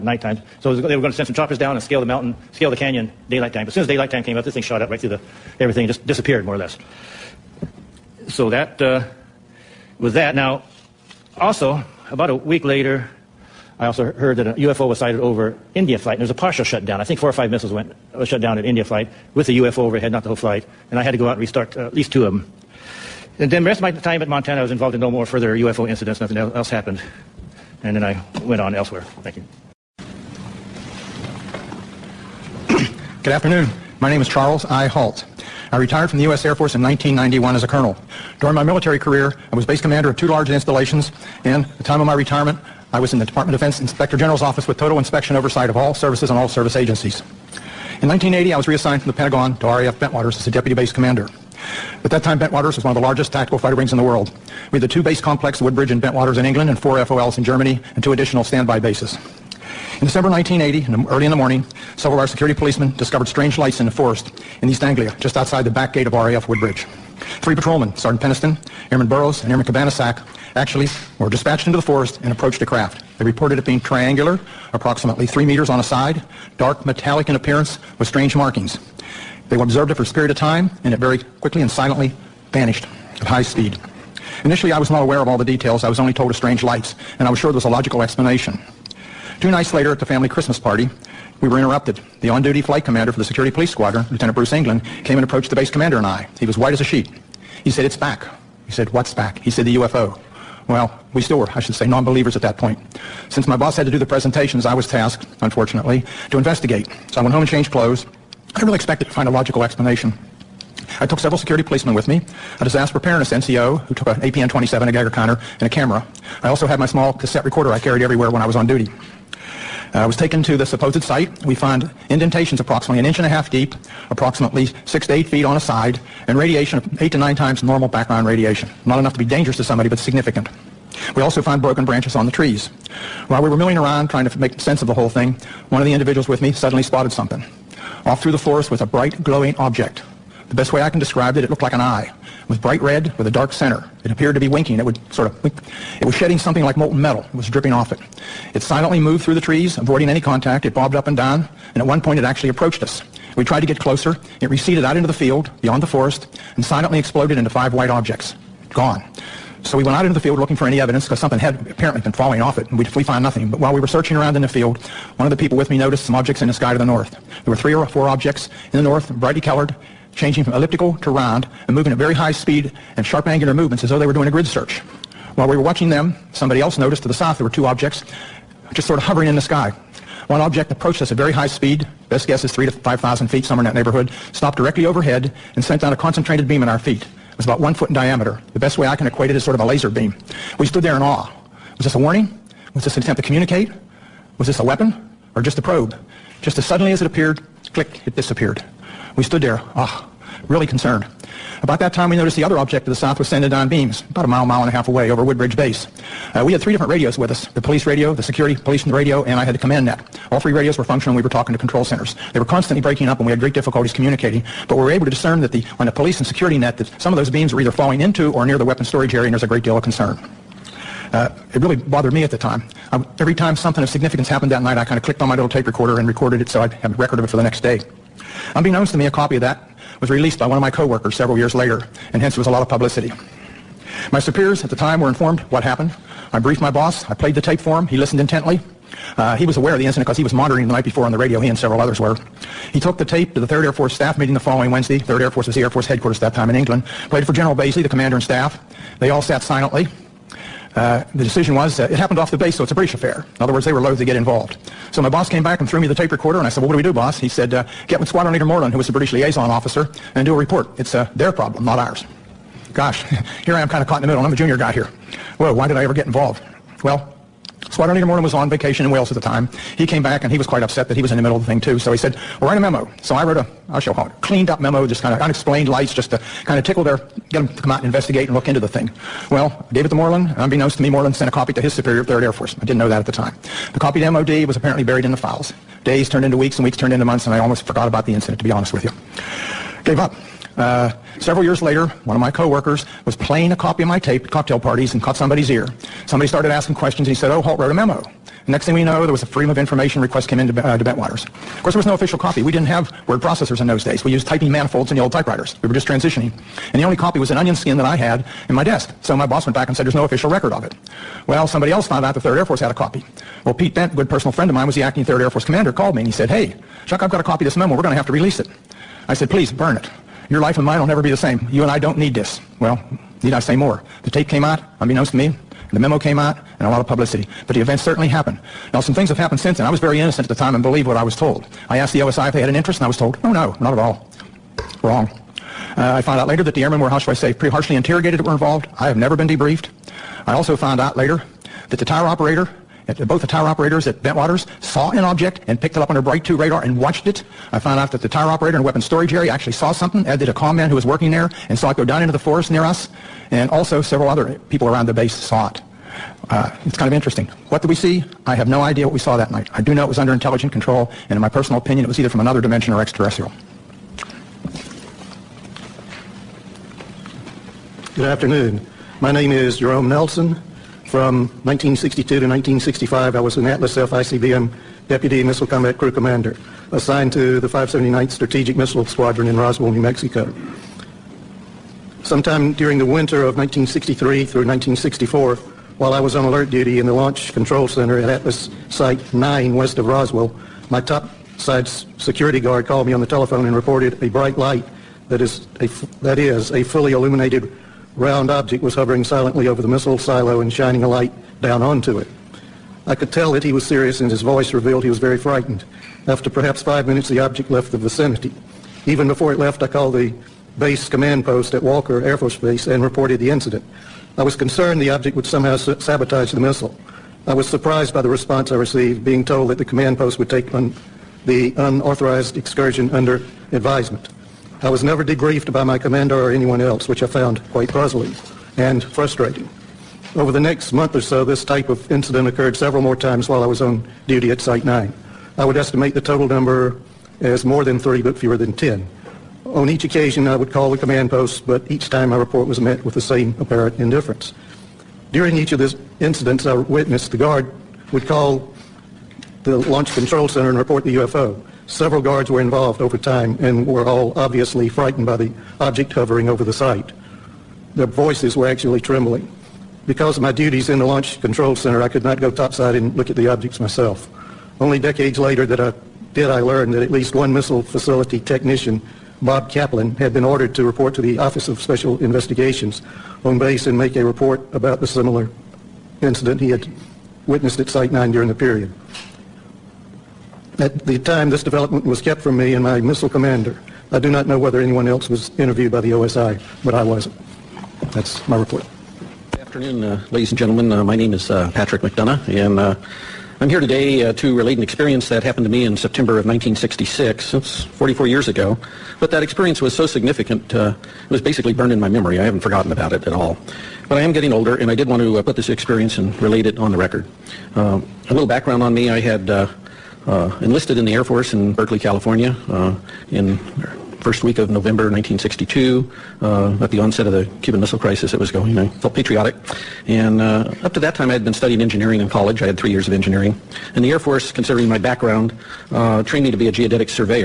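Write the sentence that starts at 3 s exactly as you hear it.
But as soon as daylight time came up, this thing shot up right through the everything just disappeared more or less.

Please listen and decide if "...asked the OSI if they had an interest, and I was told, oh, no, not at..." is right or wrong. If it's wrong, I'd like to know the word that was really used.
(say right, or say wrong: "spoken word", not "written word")
right.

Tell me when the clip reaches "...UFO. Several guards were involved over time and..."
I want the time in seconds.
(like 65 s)
450 s.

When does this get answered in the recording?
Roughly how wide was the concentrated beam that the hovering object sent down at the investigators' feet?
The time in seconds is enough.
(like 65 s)
187 s.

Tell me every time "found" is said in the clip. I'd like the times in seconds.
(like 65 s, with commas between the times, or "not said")
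163 s, 311 s, 336 s, 340 s, 347 s, 427 s.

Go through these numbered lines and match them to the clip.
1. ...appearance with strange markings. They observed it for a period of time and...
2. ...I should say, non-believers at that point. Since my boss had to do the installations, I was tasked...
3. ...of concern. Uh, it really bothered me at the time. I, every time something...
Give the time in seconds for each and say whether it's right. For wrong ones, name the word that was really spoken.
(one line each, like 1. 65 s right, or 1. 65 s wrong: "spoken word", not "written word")
1. 77 s right
2. 101 s wrong: "presentations", not "installations"
3. 219 s right.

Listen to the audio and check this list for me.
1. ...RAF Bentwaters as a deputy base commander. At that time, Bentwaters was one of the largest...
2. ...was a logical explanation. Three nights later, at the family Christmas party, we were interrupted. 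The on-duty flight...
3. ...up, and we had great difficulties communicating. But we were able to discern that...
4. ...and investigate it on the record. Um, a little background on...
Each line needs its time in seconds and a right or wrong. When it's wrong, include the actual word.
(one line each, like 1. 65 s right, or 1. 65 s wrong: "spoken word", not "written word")
1. 49 s right
2. 87 s wrong: "Two", not "Three"
3. 213 s right
4. 505 s wrong: "relate", not "investigate".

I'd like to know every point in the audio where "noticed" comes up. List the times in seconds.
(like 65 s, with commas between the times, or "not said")
165 s, 176 s, 202 s.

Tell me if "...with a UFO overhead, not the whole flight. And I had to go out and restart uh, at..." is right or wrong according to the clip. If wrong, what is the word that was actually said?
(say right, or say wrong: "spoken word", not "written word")
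right.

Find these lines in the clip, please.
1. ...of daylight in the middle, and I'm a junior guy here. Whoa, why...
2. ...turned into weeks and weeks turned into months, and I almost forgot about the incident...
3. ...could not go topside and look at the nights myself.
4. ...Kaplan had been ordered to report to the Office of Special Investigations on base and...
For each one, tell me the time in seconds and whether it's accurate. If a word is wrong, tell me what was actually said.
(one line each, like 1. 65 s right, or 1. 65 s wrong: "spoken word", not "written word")
1. 263 s wrong: "caught", not "daylight"
2. 286 s right
3. 461 s wrong: "objects", not "nights"
4. 469 s right.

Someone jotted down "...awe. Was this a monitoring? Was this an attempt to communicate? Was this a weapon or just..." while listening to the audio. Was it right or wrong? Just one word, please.
wrong.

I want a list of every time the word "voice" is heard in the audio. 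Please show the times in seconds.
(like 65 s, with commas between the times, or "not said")
404 s, 457 s.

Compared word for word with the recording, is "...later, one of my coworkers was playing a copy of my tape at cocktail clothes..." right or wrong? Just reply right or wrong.
wrong.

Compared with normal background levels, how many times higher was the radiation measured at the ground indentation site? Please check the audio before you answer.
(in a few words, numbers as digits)
8 to 9 times.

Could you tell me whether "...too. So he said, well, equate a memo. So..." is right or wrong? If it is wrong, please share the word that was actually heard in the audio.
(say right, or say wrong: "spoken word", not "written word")
wrong: "write", not "equate".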